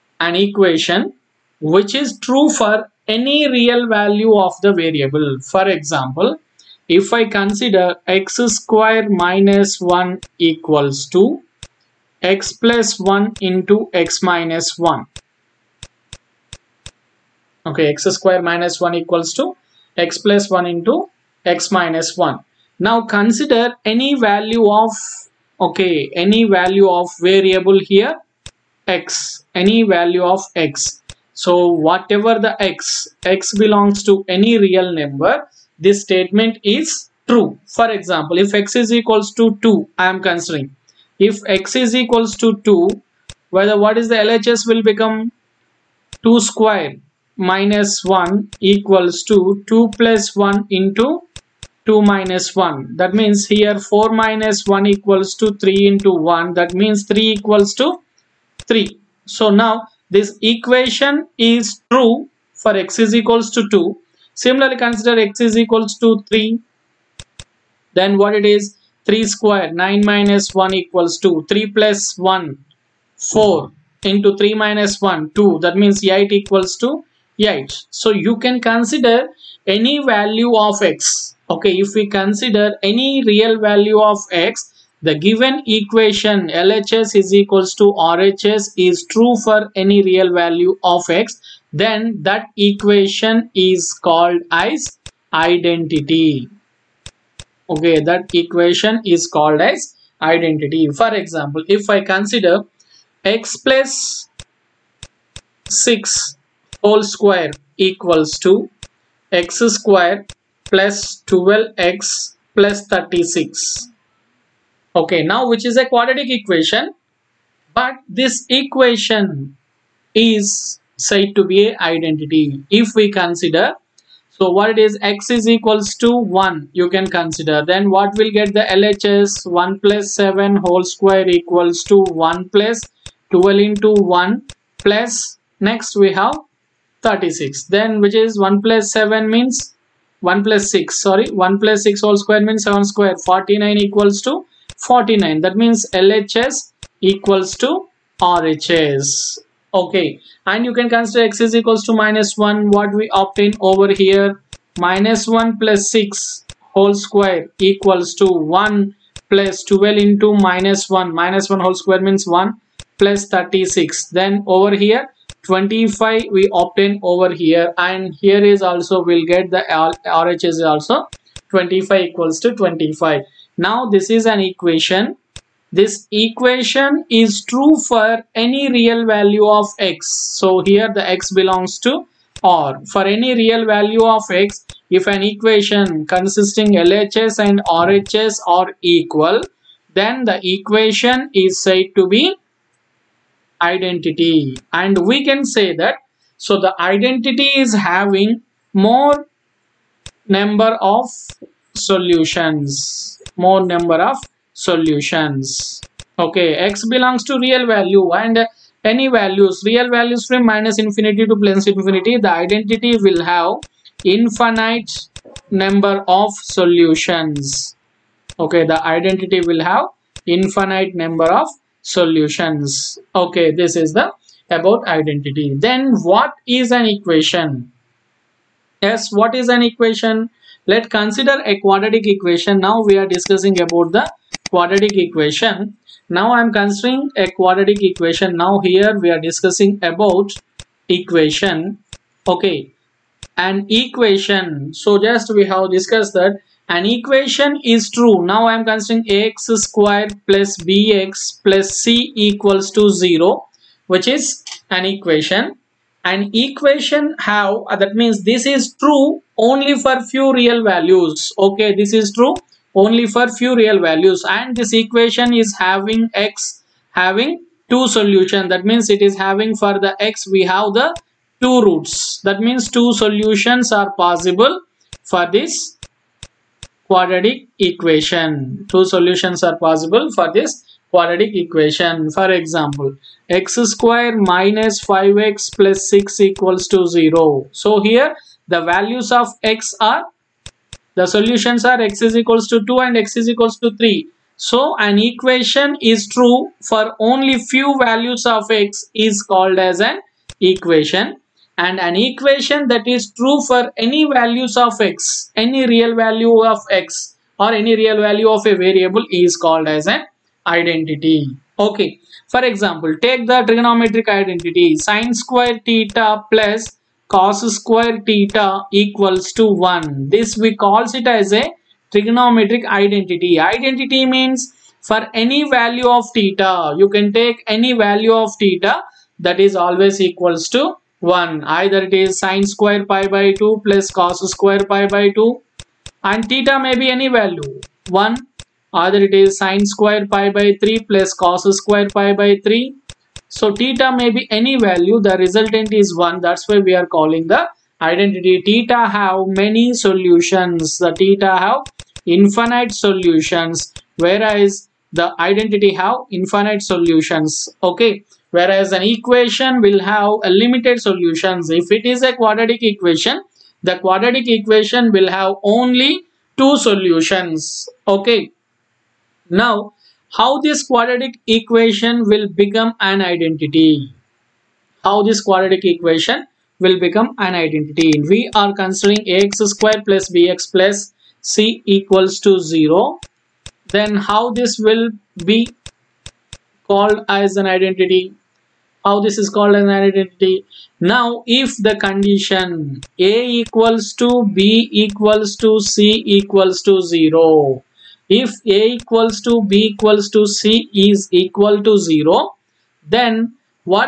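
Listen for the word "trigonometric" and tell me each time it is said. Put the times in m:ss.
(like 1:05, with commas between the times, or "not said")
5:13, 5:21.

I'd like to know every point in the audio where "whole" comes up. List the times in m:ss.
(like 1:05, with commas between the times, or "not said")
1:46, 2:10, 2:22, 2:36, 2:41.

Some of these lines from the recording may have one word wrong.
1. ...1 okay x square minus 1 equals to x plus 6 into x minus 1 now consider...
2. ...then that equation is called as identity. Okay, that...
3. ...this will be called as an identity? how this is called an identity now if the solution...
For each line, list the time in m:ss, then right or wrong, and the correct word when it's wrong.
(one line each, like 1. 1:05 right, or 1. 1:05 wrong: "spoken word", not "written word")
1. 0:14 wrong: "1", not "6"
2. 1:31 right
3. 6:24 wrong: "condition", not "solution".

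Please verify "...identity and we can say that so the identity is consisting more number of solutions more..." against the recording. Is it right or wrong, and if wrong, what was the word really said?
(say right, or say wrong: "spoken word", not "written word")
wrong: "having", not "consisting".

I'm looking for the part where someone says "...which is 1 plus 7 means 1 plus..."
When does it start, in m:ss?
2:18.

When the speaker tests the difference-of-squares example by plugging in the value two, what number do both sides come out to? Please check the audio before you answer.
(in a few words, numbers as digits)
3.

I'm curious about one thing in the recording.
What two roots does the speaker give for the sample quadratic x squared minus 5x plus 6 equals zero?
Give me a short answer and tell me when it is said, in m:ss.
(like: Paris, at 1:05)
2 and 3, at 4:51.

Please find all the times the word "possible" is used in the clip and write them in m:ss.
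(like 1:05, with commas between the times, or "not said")
4:33, 4:39.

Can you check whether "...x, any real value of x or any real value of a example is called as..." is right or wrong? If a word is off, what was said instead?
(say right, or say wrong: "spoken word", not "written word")
wrong: "variable", not "example".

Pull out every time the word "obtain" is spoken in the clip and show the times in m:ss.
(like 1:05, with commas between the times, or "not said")
2:33, 2:46.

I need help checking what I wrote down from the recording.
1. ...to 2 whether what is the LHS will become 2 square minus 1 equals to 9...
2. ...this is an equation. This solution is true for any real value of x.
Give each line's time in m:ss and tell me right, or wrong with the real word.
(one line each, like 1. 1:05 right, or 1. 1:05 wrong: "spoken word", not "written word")
1. 0:42 wrong: "2", not "9"
2. 2:53 wrong: "equation", not "solution".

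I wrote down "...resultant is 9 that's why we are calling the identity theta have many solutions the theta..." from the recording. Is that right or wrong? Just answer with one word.
wrong.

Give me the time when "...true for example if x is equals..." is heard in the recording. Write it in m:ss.
0:37.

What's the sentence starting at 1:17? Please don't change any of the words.
So you can consider any value of x.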